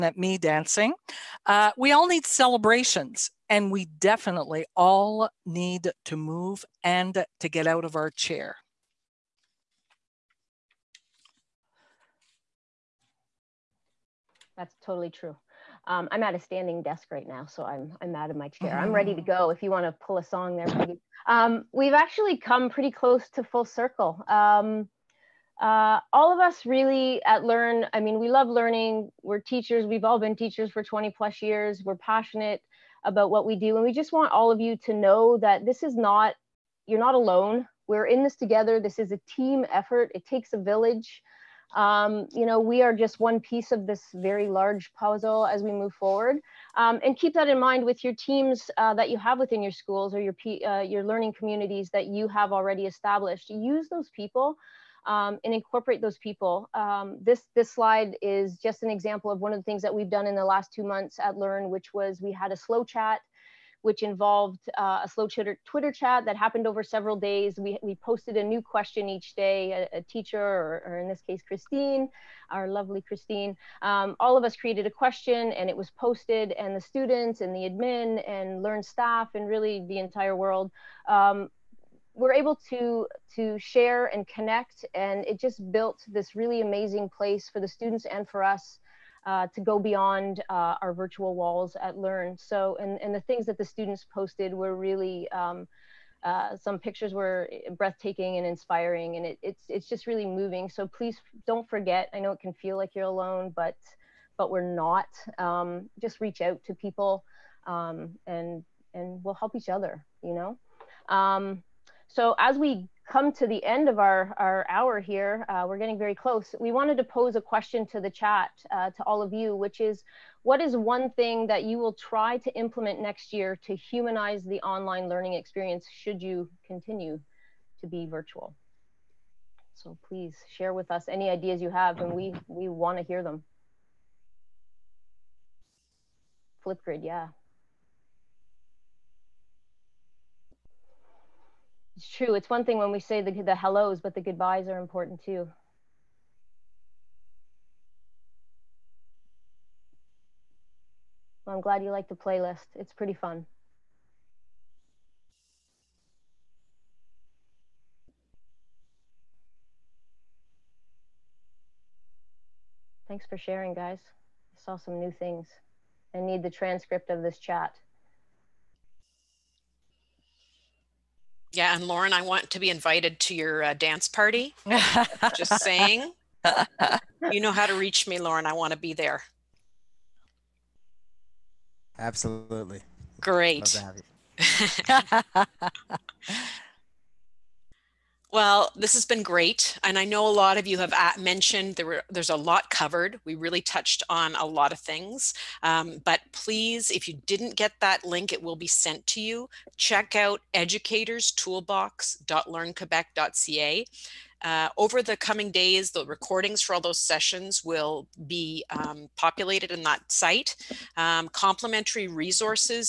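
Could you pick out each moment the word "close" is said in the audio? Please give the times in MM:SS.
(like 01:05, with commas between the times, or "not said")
00:22, 01:56.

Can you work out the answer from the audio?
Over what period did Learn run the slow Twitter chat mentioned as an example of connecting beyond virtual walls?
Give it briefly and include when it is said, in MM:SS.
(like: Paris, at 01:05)
the last two months, at 01:00.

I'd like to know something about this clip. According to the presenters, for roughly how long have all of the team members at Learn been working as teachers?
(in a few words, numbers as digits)
20 plus years.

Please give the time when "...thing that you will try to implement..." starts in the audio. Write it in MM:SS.
02:01.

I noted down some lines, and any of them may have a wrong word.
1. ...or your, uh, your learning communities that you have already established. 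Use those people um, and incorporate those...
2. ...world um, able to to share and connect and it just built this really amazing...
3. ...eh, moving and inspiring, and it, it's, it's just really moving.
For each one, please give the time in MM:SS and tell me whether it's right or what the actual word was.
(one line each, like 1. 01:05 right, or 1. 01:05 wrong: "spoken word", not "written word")
1. 00:50 right
2. 01:20 right
3. 01:37 wrong: "breathtaking", not "moving".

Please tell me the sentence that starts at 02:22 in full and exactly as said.
It's one thing when we say the, the hellos, but the goodbyes are important too.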